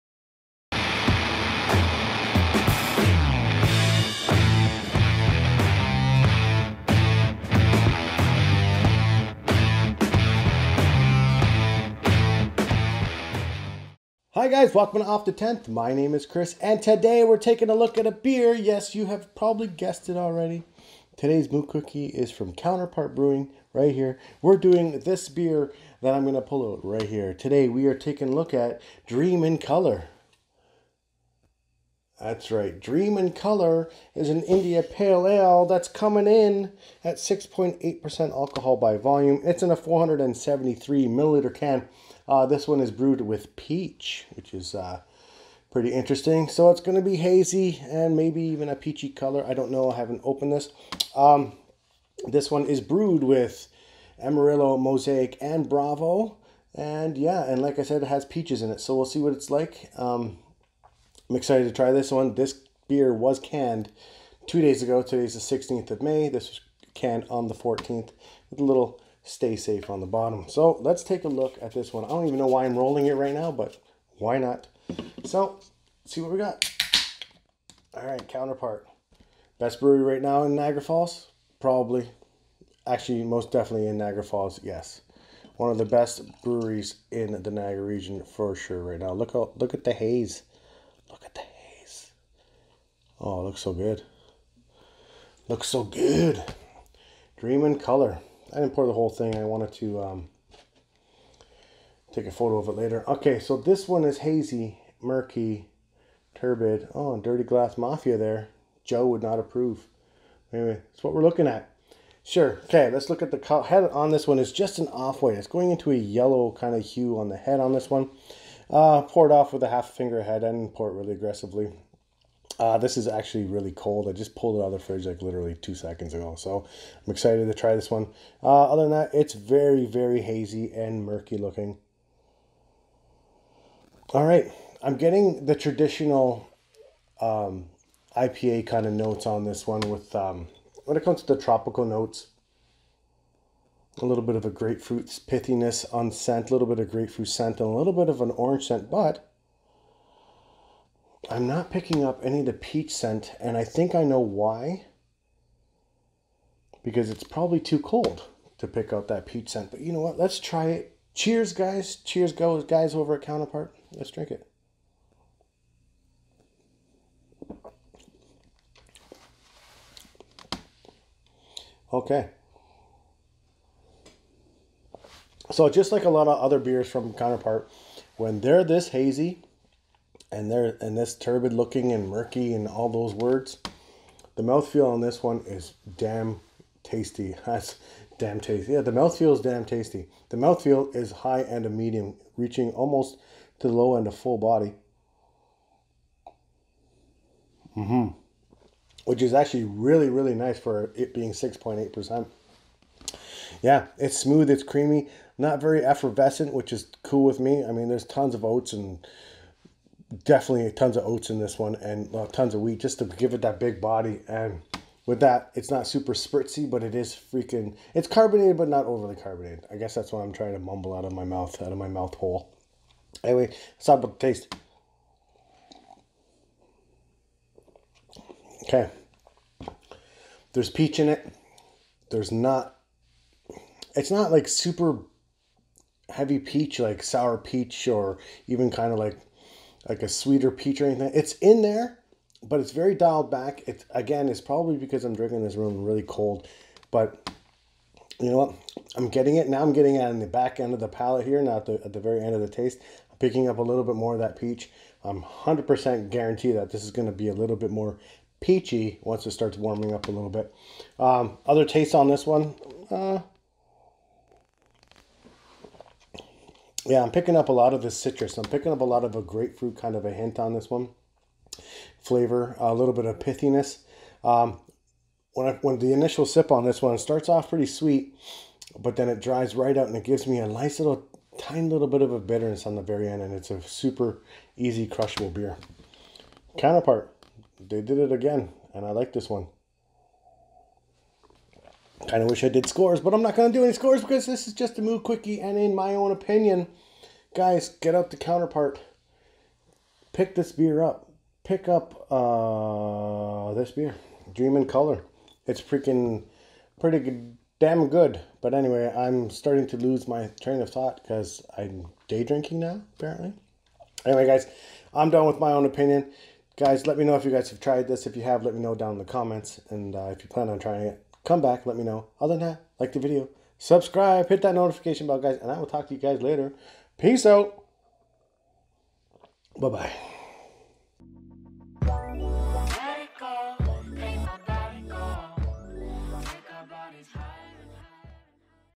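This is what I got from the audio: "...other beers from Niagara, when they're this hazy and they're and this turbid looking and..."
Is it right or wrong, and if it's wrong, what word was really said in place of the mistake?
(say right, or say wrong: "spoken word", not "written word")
wrong: "Counterpart", not "Niagara".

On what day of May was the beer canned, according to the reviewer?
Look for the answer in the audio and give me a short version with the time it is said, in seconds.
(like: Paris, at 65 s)
14th, at 67 s.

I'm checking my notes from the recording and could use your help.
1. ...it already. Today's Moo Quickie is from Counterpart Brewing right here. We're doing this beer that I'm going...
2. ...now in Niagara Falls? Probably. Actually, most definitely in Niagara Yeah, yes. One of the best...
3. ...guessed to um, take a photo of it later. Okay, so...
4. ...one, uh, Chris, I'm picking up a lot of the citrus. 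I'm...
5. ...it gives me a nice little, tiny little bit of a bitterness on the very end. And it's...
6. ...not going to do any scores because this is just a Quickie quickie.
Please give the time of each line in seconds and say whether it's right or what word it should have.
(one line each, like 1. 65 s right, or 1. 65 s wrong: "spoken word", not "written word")
1. 20 s right
2. 80 s wrong: "Falls", not "Yeah"
3. 99 s wrong: "wanted", not "guessed"
4. 262 s wrong: "Yeah", not "Chris"
5. 279 s right
6. 293 s wrong: "Moo", not "Quickie".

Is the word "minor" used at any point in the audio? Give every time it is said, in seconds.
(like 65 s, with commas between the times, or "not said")
not said.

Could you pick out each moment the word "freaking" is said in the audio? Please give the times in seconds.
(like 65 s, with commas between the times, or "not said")
217 s, 305 s.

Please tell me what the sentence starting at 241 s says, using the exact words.
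It's in there, but it's very dialed back.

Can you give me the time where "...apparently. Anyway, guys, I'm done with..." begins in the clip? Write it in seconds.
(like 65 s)
312 s.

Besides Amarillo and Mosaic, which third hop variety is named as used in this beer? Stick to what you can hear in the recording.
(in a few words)
Bravo.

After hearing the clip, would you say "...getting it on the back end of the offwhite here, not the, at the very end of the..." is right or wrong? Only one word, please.
wrong.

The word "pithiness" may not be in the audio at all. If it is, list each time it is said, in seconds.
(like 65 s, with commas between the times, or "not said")
145 s, 273 s.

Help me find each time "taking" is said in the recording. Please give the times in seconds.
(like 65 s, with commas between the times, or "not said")
17 s, 27 s.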